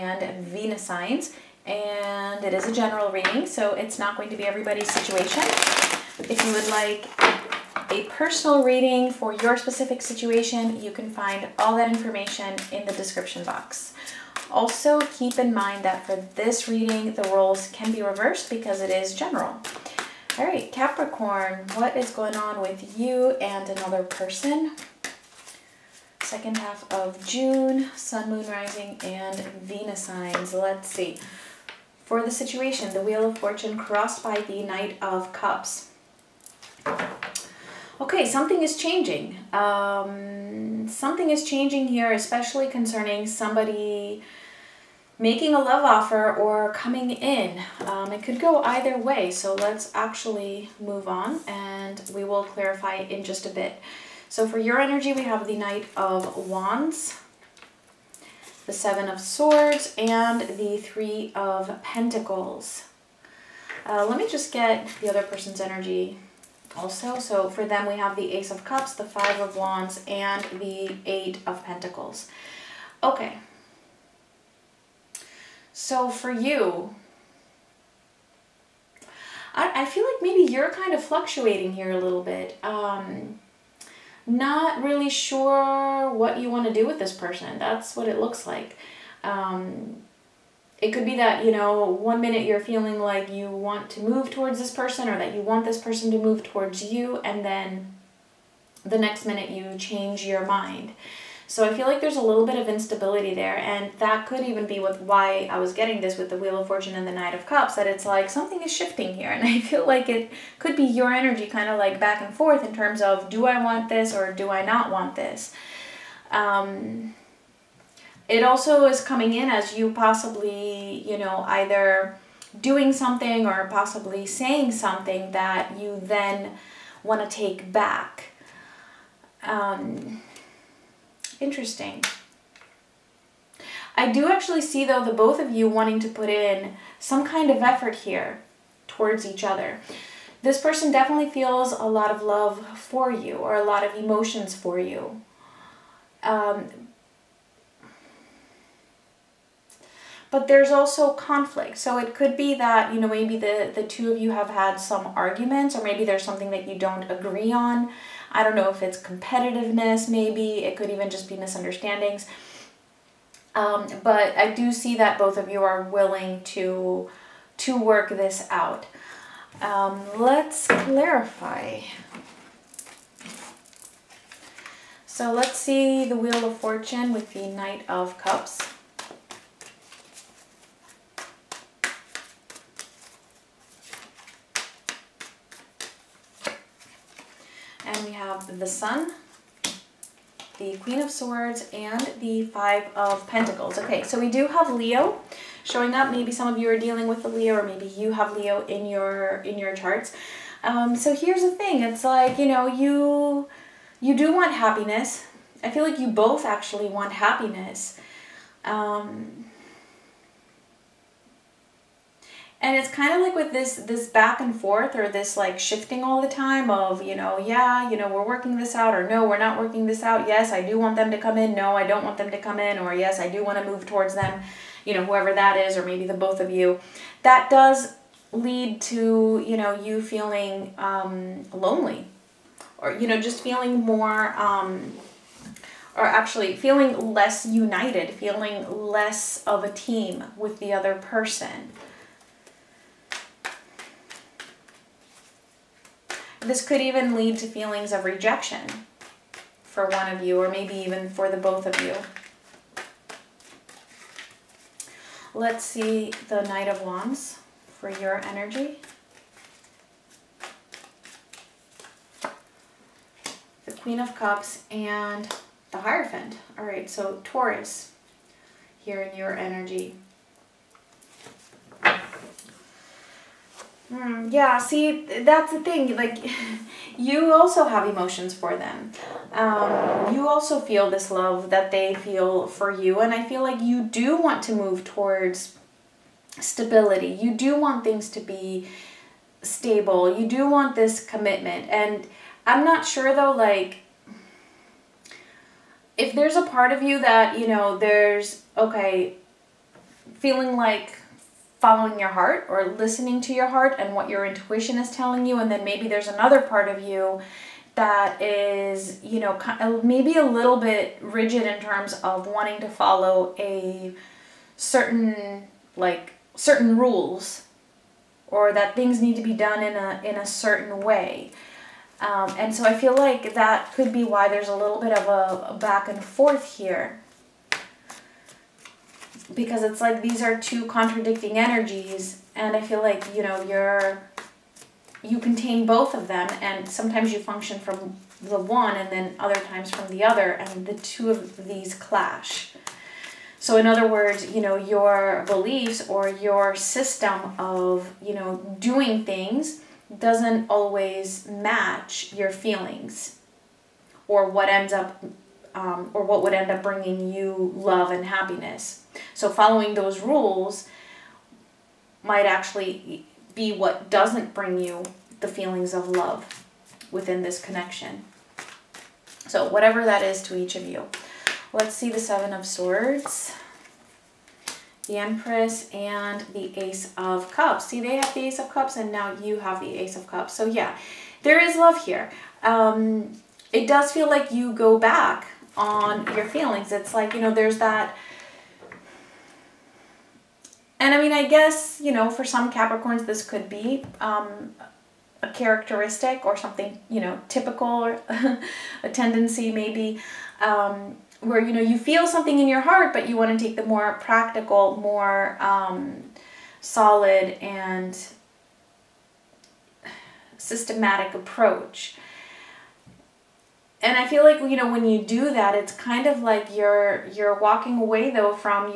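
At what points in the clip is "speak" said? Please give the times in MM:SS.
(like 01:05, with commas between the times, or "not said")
not said.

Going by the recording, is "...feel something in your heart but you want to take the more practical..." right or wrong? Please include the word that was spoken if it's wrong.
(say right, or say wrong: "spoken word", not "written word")
right.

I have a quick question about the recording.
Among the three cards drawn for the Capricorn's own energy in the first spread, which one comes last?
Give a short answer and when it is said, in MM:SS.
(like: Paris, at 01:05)
Three of Pentacles, at 01:00.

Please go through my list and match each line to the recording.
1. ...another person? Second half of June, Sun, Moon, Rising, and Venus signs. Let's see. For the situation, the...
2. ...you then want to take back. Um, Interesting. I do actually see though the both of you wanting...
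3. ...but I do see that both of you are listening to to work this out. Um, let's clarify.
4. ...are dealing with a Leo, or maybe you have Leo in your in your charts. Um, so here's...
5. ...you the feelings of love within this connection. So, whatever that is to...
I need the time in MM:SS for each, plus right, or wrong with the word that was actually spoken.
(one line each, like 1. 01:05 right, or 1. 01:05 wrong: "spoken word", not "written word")
1. 00:23 right
2. 02:05 right
3. 02:44 wrong: "willing", not "listening"
4. 03:16 right
5. 06:04 right.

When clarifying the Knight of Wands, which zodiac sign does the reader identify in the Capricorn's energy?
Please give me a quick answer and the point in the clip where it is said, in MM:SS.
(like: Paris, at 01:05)
Taurus, at 04:27.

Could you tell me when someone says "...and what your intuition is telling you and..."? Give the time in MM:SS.
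05:03.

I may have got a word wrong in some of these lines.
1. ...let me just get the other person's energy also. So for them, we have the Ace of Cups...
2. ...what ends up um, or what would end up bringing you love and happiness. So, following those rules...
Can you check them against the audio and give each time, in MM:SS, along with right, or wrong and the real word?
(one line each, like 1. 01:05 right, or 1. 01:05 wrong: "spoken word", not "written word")
1. 01:04 right
2. 05:54 right.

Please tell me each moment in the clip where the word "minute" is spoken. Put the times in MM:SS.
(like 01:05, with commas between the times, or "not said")
01:32, 01:39.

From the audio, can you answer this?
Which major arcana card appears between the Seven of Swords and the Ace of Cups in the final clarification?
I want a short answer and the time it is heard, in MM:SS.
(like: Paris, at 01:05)
The Empress, at 06:14.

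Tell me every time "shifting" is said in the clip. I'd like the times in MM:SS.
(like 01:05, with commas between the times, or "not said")
01:48, 03:35.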